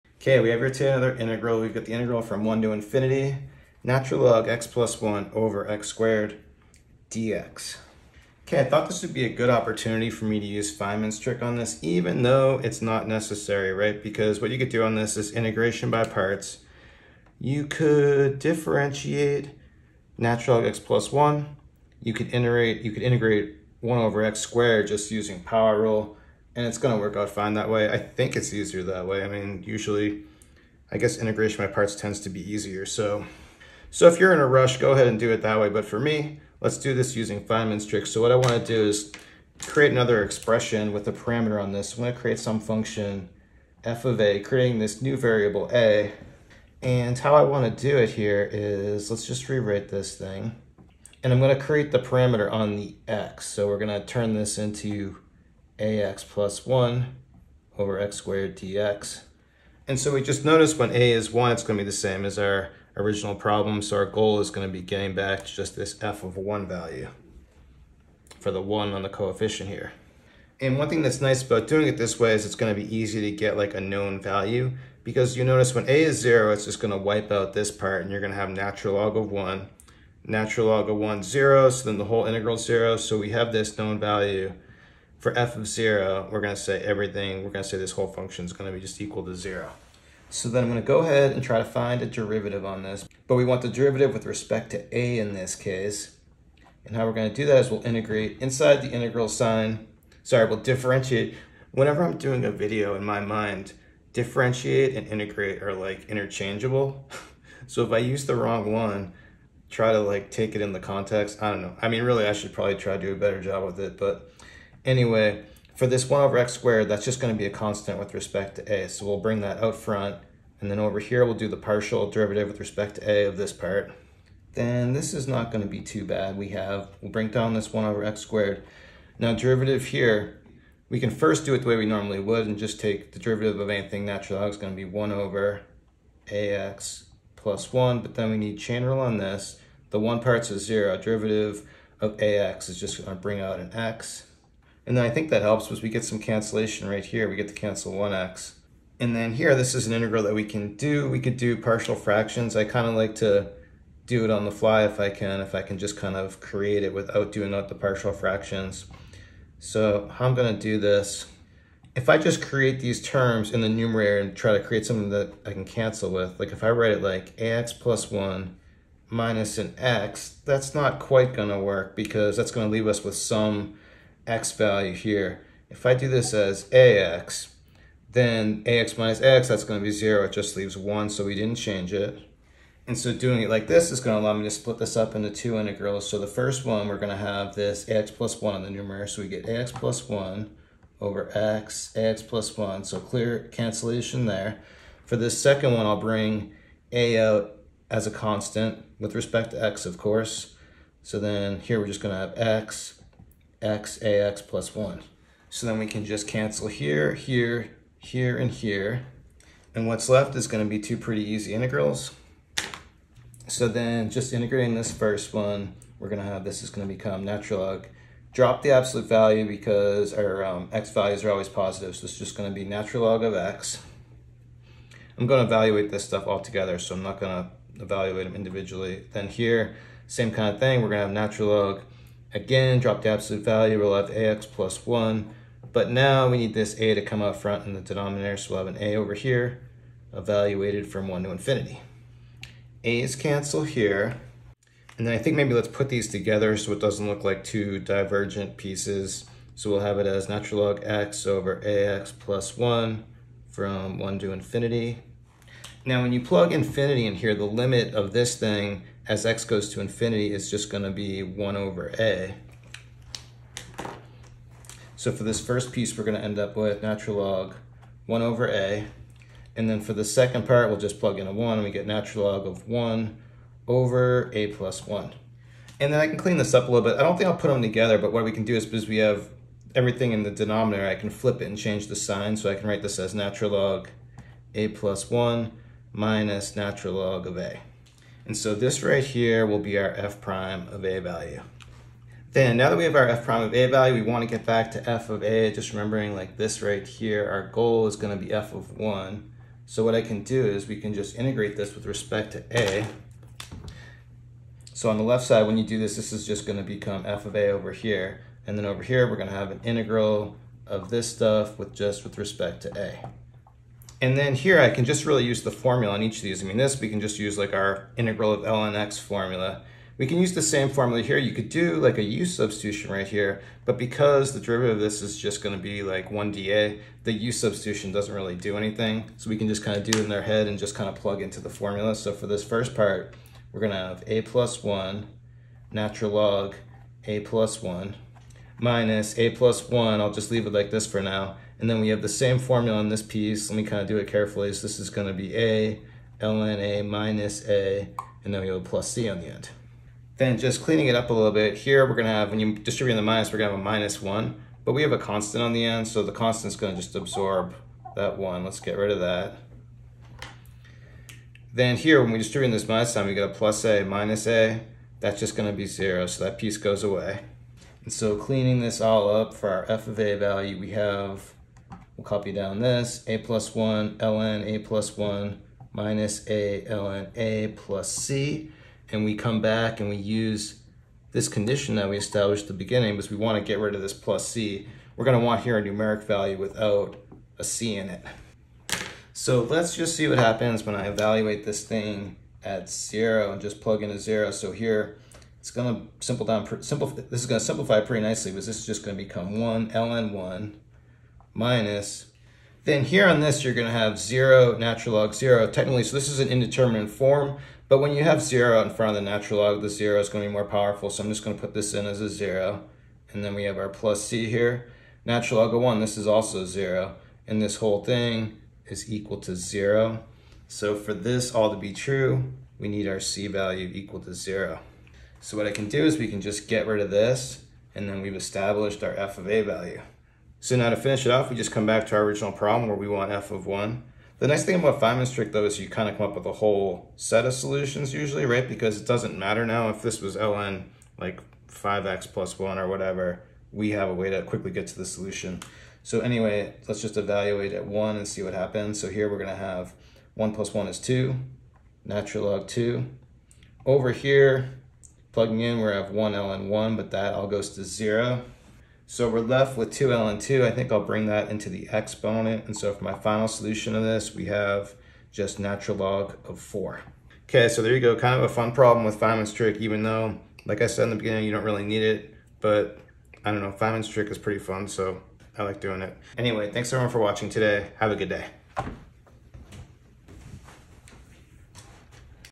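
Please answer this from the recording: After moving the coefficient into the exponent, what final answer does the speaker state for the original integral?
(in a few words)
ln 4.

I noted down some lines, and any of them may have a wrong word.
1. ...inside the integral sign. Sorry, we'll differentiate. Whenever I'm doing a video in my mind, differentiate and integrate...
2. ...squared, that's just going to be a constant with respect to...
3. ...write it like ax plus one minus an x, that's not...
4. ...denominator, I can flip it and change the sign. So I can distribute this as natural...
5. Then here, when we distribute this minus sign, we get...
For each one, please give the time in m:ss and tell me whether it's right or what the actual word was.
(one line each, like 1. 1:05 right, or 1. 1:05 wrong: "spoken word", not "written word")
1. 1:38 right
2. 1:56 right
3. 2:46 right
4. 4:40 wrong: "write", not "distribute"
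5. 6:01 right.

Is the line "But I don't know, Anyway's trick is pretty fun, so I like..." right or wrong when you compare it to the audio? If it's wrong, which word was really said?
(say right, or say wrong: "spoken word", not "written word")
wrong: "Feynman", not "Anyway".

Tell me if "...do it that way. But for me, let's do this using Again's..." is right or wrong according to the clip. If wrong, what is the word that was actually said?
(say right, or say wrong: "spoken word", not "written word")
wrong: "Feynman", not "Again".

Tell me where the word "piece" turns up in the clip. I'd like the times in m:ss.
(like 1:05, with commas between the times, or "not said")
4:08, 4:25, 5:43, 6:06.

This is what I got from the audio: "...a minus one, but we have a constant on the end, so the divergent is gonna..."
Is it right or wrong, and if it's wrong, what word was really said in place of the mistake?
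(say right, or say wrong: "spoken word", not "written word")
wrong: "constant", not "divergent".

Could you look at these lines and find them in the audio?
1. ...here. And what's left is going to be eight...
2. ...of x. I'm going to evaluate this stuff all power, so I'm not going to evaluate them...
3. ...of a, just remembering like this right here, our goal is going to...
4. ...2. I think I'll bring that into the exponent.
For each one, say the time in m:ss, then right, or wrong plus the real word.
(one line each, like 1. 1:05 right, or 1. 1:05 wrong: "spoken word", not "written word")
1. 3:28 wrong: "two", not "eight"
2. 3:43 wrong: "together", not "power"
3. 4:55 right
4. 7:40 right.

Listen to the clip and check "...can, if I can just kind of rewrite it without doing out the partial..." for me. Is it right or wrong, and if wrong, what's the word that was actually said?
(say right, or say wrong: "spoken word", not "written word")
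wrong: "create", not "rewrite".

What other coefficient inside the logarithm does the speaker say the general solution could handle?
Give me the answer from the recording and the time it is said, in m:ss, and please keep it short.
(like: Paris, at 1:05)
5, at 7:20.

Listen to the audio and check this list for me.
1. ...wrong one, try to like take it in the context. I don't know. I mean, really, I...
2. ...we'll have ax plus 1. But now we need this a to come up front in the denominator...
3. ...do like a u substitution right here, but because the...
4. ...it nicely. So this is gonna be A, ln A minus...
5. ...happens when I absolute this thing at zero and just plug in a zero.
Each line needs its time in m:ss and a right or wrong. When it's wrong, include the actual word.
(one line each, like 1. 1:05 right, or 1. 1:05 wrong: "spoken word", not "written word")
1. 1:48 right
2. 3:53 right
3. 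5:21 right
4. 5:43 wrong: "carefully", not "nicely"
5. 6:30 wrong: "evaluate", not "absolute".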